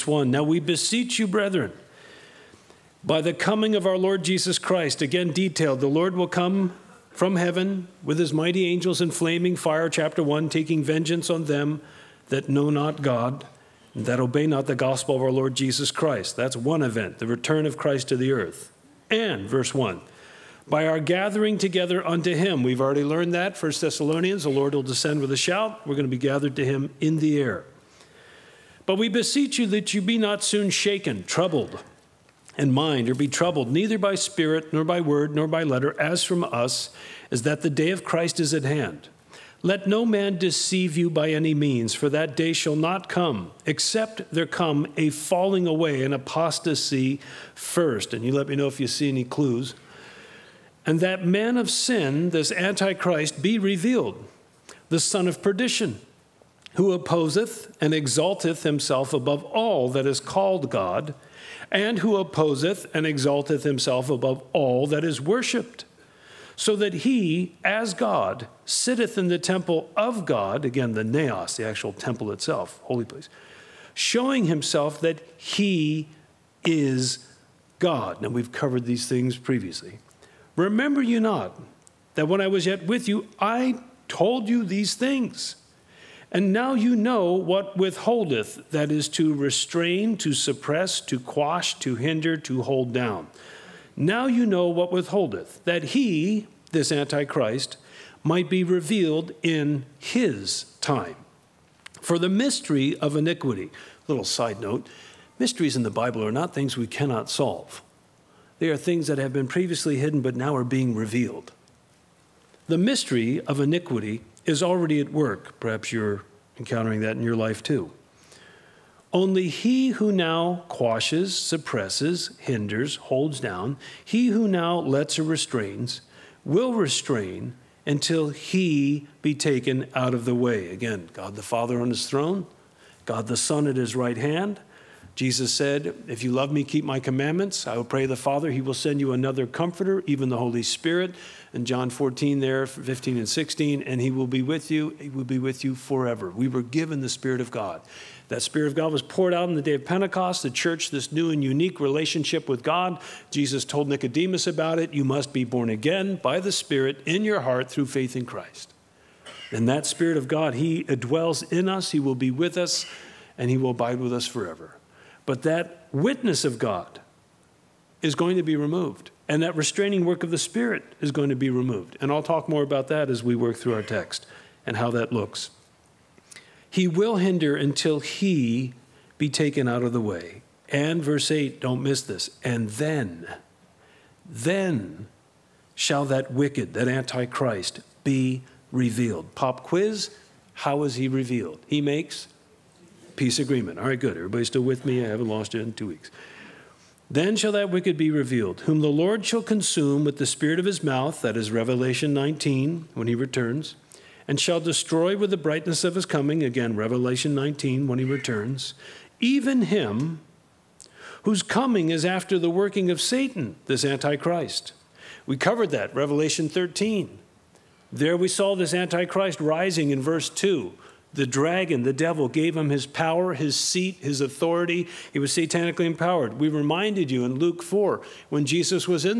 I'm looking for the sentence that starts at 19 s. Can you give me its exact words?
And, verse 1, by our gathering together unto him.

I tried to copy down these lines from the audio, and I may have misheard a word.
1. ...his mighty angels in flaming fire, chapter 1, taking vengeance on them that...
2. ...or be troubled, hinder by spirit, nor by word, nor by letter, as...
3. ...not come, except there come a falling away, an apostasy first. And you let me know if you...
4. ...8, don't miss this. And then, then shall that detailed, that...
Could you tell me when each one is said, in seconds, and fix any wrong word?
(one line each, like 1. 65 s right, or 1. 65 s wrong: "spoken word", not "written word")
1. 8 s right
2. 33 s wrong: "neither", not "hinder"
3. 42 s right
4. 181 s wrong: "wicked", not "detailed".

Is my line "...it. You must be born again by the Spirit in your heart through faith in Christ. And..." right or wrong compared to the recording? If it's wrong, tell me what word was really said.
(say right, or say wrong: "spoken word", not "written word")
right.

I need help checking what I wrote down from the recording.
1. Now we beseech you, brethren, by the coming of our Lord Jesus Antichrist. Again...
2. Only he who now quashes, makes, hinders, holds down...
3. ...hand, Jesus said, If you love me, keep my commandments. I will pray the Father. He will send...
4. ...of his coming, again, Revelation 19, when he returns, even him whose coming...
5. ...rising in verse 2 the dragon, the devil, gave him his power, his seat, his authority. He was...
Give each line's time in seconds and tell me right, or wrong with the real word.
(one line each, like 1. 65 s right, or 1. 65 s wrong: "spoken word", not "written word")
1. 0 s wrong: "Christ", not "Antichrist"
2. 119 s wrong: "suppresses", not "makes"
3. 134 s right
4. 205 s right
5. 219 s right.